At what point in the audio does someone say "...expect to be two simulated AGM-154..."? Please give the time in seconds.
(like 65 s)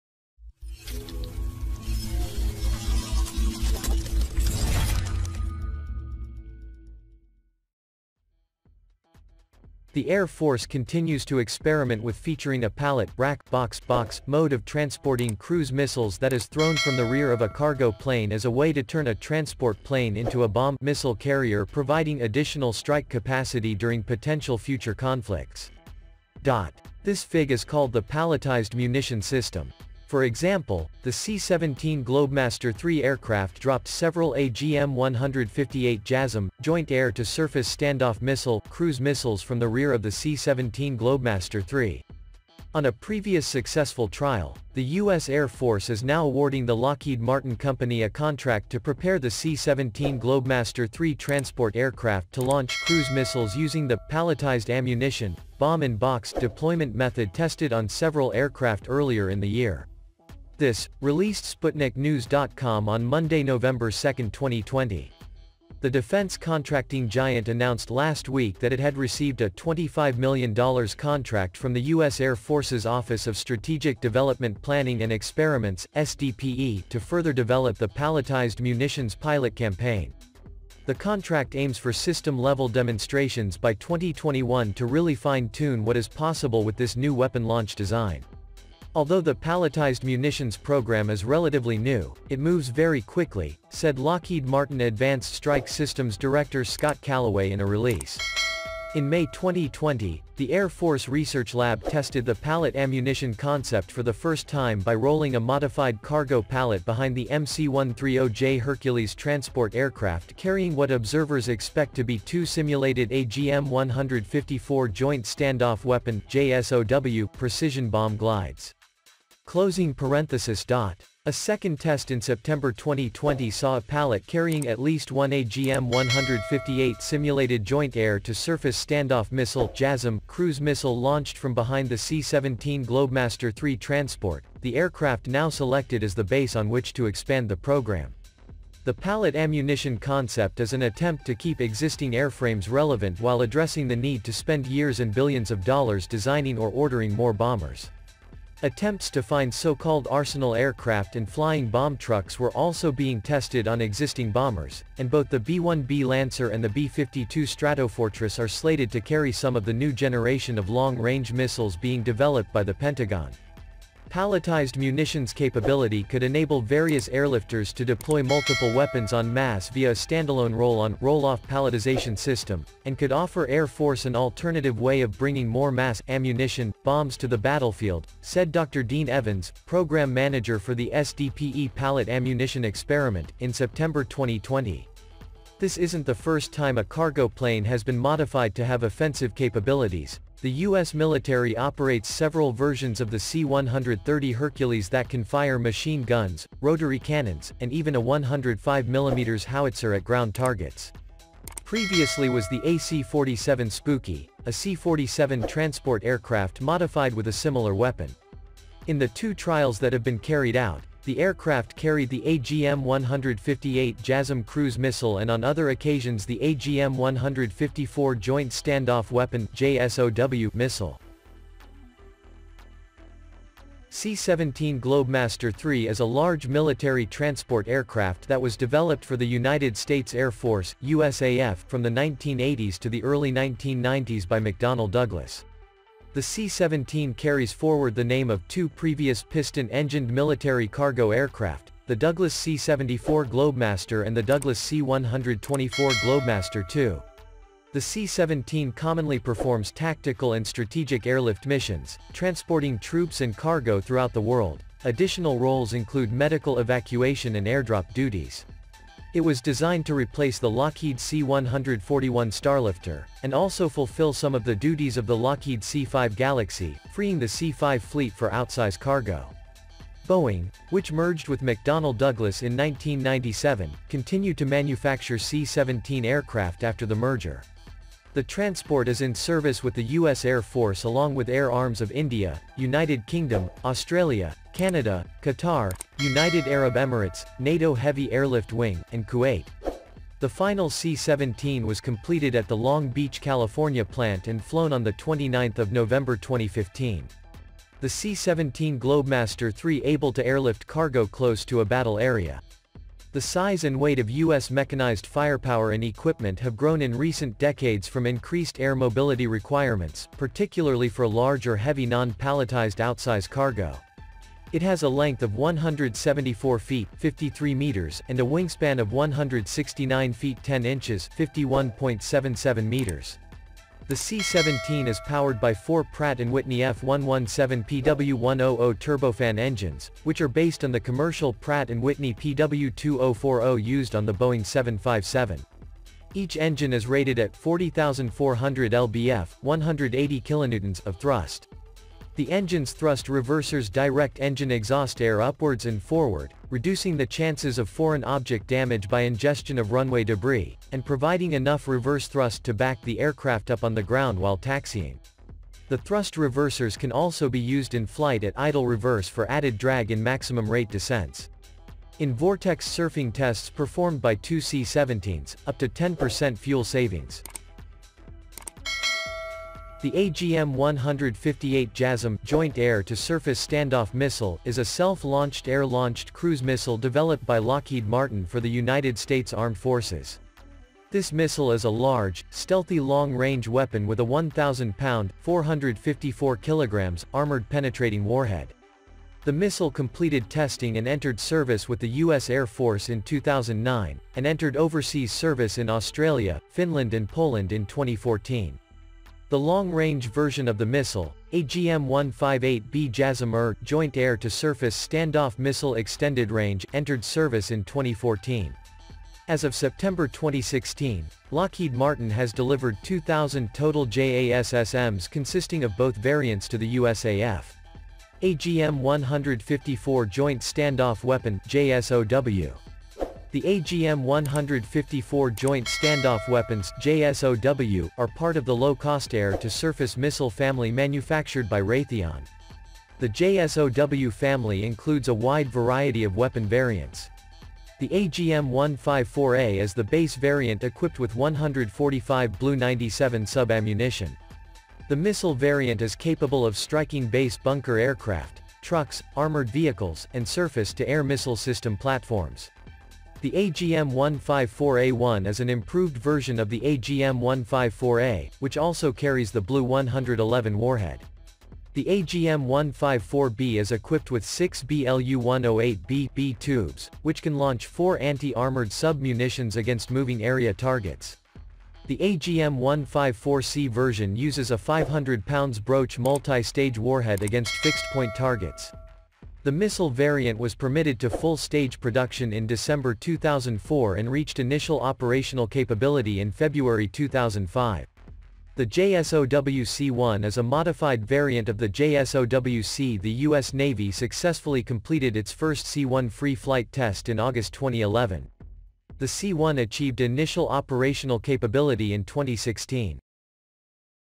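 111 s.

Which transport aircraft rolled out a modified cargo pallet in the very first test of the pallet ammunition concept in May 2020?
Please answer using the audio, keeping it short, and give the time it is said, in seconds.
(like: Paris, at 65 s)
MC-130J Hercules, at 107 s.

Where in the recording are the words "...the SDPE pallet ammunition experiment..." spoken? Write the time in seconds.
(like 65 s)
180 s.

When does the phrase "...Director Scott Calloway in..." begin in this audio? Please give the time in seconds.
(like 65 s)
96 s.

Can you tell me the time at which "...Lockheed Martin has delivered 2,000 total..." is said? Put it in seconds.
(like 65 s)
411 s.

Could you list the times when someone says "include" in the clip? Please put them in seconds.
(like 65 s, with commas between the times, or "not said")
255 s, 434 s.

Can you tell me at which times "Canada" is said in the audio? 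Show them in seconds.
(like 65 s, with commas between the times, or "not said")
284 s.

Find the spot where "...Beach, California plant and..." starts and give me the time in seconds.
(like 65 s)
292 s.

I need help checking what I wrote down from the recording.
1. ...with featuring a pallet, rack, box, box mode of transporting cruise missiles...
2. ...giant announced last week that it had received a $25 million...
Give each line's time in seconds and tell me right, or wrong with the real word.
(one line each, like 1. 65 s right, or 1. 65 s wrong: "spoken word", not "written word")
1. 12 s right
2. 67 s right.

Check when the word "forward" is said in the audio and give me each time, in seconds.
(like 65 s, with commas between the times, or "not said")
237 s, 345 s.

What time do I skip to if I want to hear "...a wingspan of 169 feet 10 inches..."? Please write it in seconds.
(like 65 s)
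318 s.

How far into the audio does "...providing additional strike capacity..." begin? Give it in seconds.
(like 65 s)
21 s.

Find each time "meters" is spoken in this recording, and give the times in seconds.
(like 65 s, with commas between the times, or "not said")
317 s, 322 s.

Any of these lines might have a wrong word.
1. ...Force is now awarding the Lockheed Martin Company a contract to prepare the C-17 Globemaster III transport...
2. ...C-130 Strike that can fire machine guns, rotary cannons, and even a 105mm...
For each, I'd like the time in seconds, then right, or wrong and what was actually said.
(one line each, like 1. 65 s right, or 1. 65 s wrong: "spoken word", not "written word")
1. 45 s right
2. 193 s wrong: "Hercules", not "Strike".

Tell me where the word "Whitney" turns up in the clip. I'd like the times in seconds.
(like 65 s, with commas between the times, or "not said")
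326 s, 331 s.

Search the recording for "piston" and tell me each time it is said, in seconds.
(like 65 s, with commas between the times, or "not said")
239 s.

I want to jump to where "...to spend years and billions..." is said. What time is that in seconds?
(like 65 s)
144 s.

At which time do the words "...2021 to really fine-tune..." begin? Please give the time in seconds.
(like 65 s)
83 s.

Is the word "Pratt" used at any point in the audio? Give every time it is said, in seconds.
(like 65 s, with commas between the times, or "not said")
325 s, 331 s.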